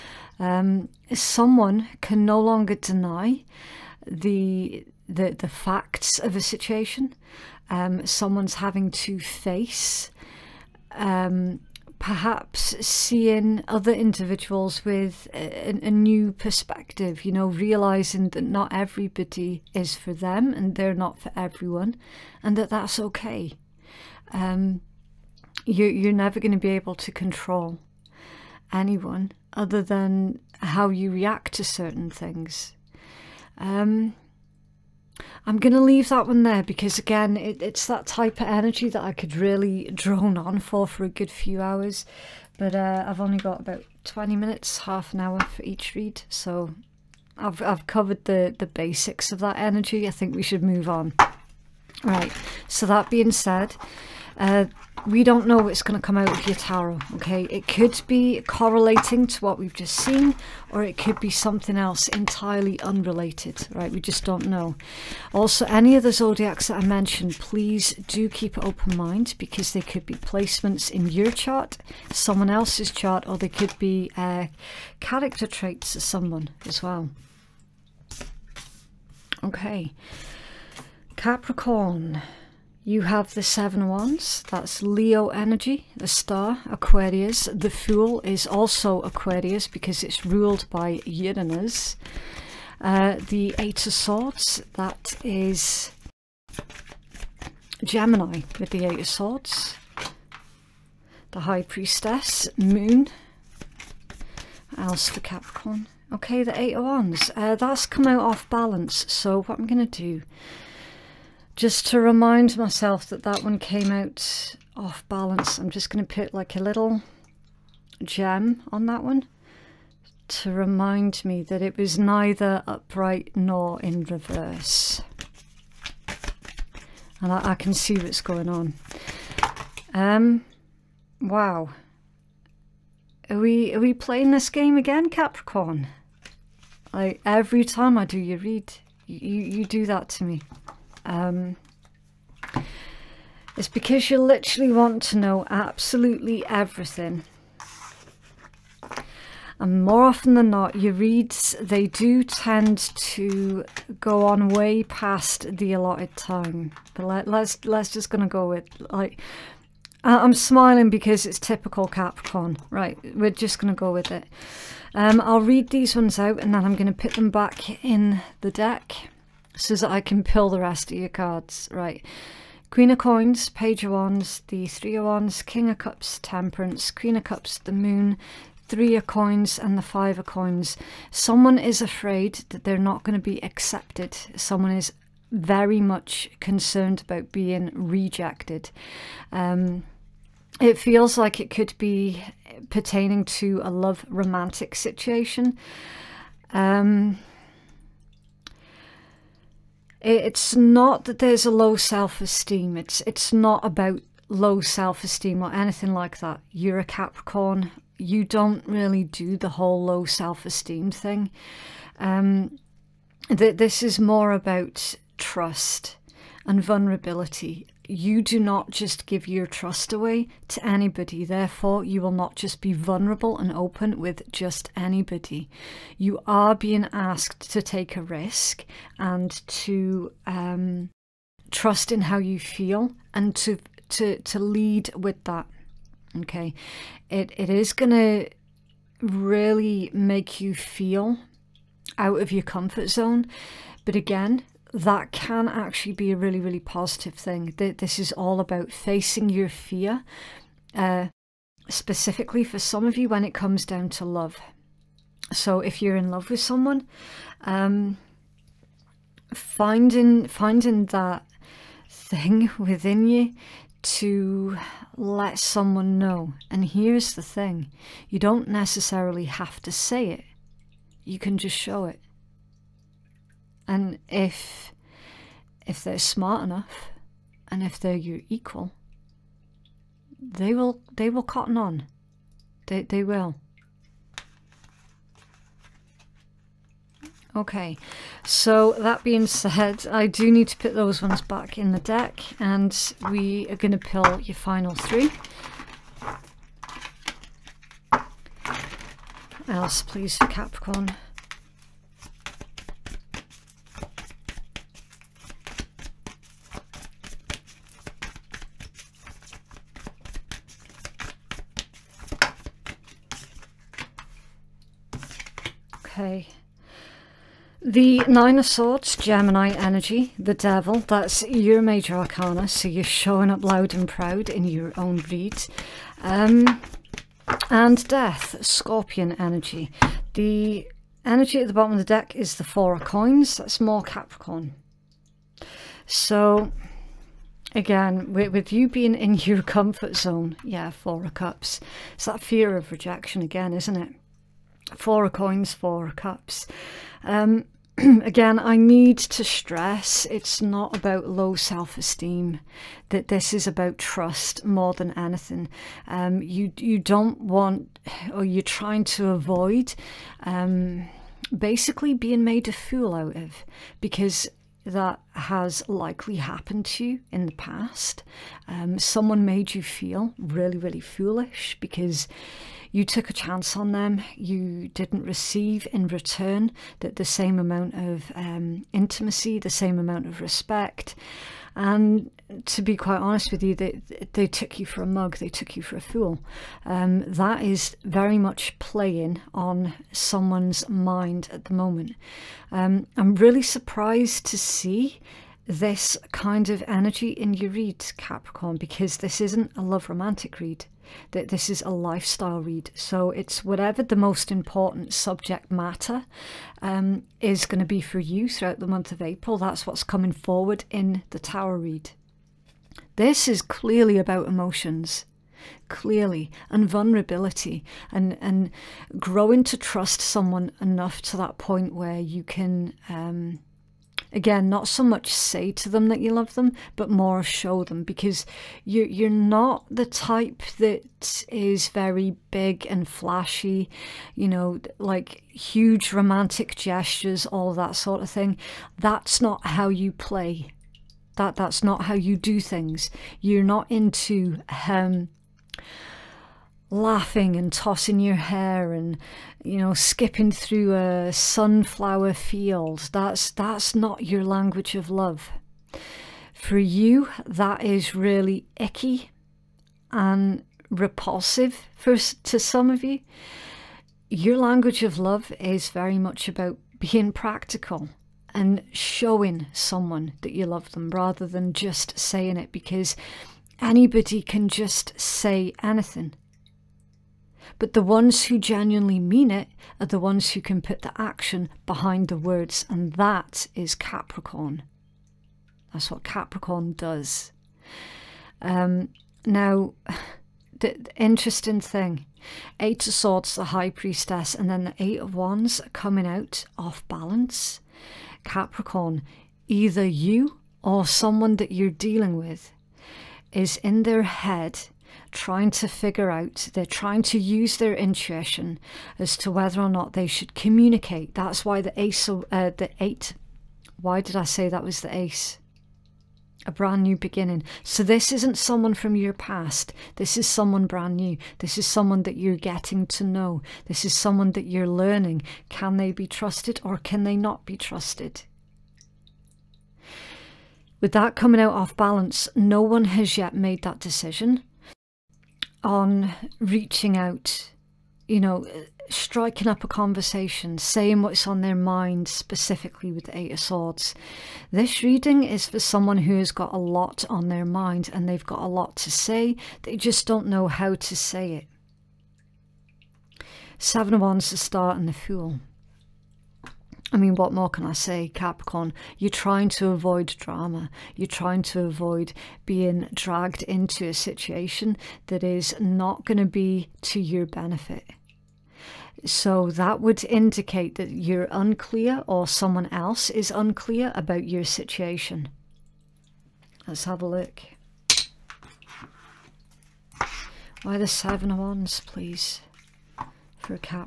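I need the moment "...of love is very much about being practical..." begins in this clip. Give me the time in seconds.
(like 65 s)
464 s.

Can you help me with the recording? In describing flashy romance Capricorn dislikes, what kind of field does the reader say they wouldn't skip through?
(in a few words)
sunflower field.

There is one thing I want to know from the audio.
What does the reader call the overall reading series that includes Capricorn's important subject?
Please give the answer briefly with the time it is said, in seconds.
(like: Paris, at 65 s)
Tower read, at 411 s.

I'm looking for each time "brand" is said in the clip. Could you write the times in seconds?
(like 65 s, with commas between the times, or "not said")
516 s, 520 s.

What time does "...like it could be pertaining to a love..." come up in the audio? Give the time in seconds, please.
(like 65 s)
191 s.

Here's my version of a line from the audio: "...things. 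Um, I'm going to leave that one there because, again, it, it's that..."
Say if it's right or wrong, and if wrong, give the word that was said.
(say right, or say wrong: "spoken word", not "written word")
right.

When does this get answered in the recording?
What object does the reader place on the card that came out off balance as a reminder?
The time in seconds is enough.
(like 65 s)
116 s.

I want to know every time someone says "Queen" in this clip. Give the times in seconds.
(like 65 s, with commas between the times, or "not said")
172 s, 176 s.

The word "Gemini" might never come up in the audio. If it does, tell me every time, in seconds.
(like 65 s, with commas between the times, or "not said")
97 s, 318 s.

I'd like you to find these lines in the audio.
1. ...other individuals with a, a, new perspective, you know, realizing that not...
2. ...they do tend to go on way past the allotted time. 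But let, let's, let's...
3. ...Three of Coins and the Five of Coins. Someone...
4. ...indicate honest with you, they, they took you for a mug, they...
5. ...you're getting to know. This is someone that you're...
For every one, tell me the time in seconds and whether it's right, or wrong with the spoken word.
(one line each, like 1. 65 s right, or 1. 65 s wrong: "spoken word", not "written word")
1. 13 s right
2. 151 s right
3. 178 s right
4. 382 s wrong: "quite", not "indicate"
5. 522 s right.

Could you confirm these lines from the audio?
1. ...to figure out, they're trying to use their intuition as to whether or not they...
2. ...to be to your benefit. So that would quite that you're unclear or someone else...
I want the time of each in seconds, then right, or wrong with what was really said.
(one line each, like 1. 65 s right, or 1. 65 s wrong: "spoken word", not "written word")
1. 505 s right
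2. 566 s wrong: "indicate", not "quite".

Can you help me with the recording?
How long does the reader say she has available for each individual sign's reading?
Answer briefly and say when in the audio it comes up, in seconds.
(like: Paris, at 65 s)
20 minutes, half an hour, at 44 s.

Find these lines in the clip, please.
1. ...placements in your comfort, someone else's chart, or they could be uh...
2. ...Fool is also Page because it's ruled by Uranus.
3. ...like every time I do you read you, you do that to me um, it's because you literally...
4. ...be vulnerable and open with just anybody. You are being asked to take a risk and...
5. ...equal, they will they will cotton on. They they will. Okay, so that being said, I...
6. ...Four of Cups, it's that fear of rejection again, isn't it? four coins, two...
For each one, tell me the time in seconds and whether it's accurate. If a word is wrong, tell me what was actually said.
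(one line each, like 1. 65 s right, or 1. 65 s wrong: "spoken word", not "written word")
1. 70 s wrong: "chart", not "comfort"
2. 87 s wrong: "Aquarius", not "Page"
3. 136 s right
4. 222 s right
5. 278 s right
6. 340 s wrong: "four", not "two".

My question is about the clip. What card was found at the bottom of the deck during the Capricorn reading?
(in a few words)
Four of Coins.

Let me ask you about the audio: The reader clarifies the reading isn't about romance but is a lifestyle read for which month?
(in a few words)
April.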